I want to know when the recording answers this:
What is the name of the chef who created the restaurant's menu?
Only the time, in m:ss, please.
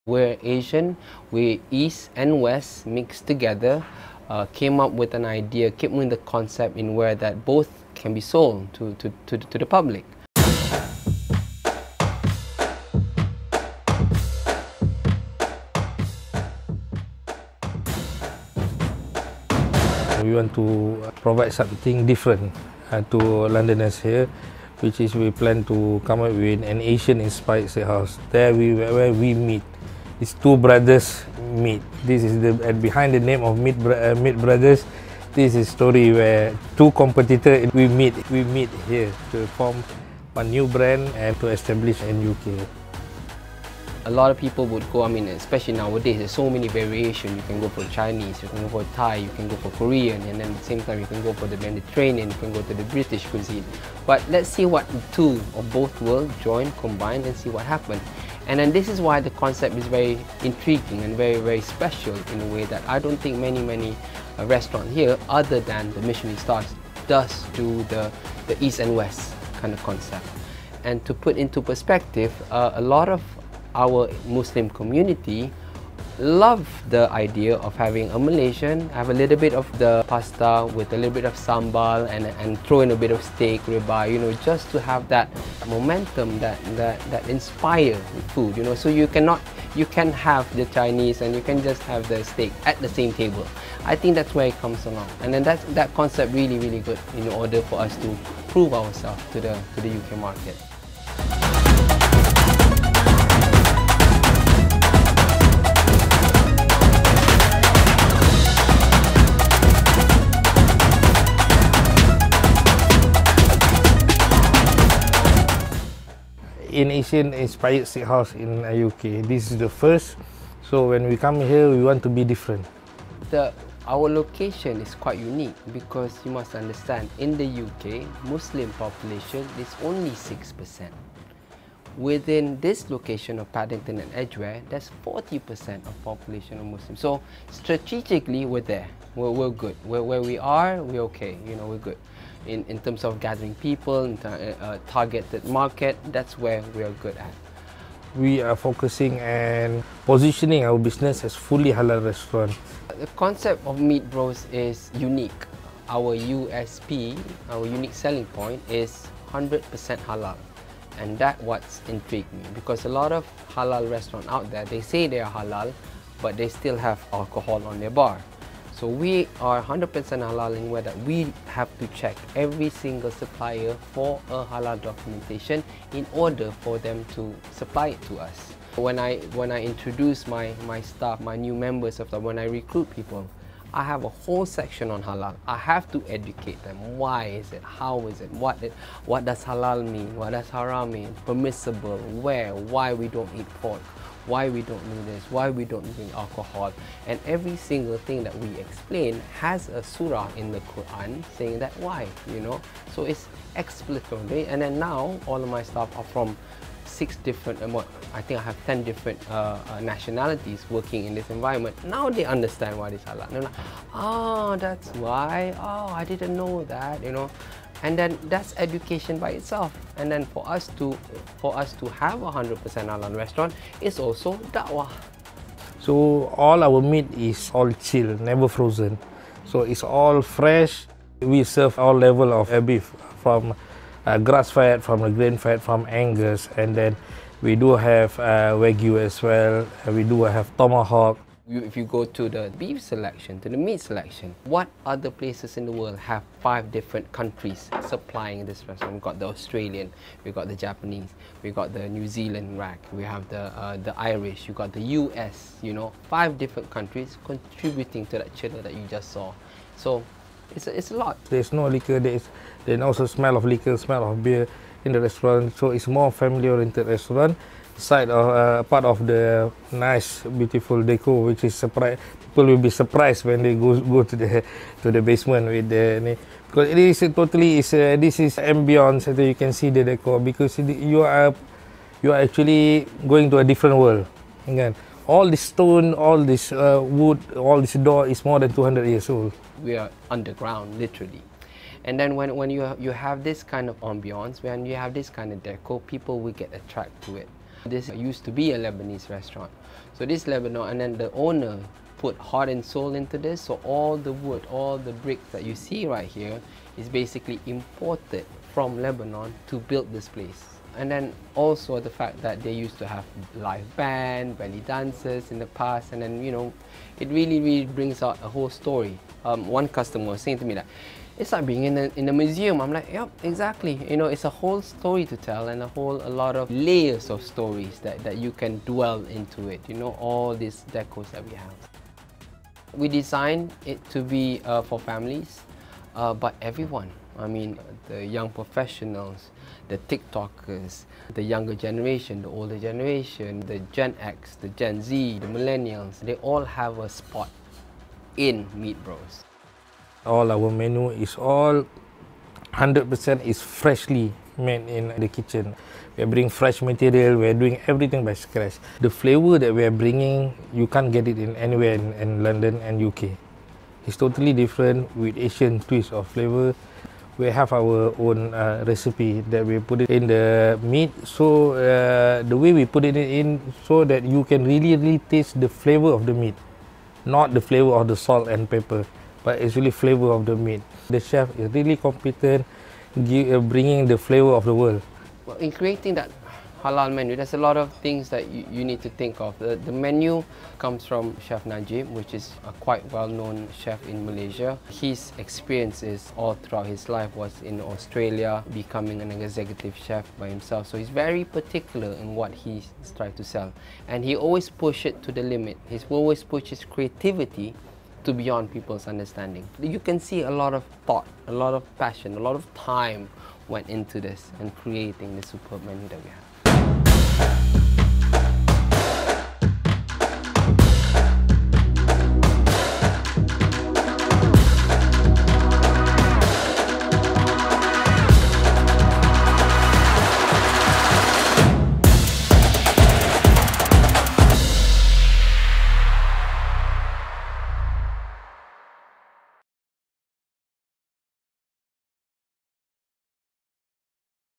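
6:31.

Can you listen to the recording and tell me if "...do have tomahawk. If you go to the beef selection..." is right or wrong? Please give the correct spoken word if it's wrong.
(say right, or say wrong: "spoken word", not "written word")
right.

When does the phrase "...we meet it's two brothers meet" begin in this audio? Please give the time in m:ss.
0:29.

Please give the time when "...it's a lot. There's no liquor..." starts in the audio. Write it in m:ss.
4:20.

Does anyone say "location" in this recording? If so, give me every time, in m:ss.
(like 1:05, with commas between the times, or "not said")
2:04, 2:12.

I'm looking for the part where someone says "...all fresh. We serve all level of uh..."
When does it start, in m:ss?
3:49.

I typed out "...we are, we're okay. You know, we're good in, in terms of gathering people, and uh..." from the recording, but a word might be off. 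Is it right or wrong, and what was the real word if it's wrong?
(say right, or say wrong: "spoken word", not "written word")
right.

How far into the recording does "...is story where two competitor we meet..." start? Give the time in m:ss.
0:35.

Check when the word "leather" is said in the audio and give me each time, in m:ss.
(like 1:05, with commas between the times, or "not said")
not said.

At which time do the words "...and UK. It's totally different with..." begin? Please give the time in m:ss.
6:02.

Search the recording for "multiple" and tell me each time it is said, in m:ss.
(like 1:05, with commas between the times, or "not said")
not said.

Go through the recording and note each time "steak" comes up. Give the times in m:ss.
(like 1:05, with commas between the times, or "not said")
1:23, 1:32.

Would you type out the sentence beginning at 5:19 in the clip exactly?
Um, one customer was saying to me that it's like being in a, in a museum.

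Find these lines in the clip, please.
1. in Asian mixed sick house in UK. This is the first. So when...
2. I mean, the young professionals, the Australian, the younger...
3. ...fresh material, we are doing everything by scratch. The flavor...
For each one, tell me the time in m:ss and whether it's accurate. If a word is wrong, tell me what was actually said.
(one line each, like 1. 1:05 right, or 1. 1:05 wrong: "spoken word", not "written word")
1. 1:56 wrong: "inspired", not "mixed"
2. 5:37 wrong: "TikTokers", not "Australian"
3. 5:56 right.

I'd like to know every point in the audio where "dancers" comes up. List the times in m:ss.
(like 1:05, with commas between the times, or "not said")
5:14.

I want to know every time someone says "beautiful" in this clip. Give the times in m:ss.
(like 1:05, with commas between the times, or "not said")
4:30.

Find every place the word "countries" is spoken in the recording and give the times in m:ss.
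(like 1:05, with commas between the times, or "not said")
4:07, 4:16.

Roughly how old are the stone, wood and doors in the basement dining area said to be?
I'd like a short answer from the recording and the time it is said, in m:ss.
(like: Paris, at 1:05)
more than 200 years, at 4:48.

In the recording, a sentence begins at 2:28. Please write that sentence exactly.
We are focusing and positioning our business as fully halal restaurant.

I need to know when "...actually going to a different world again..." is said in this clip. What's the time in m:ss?
4:42.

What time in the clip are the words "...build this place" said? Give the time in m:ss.
5:09.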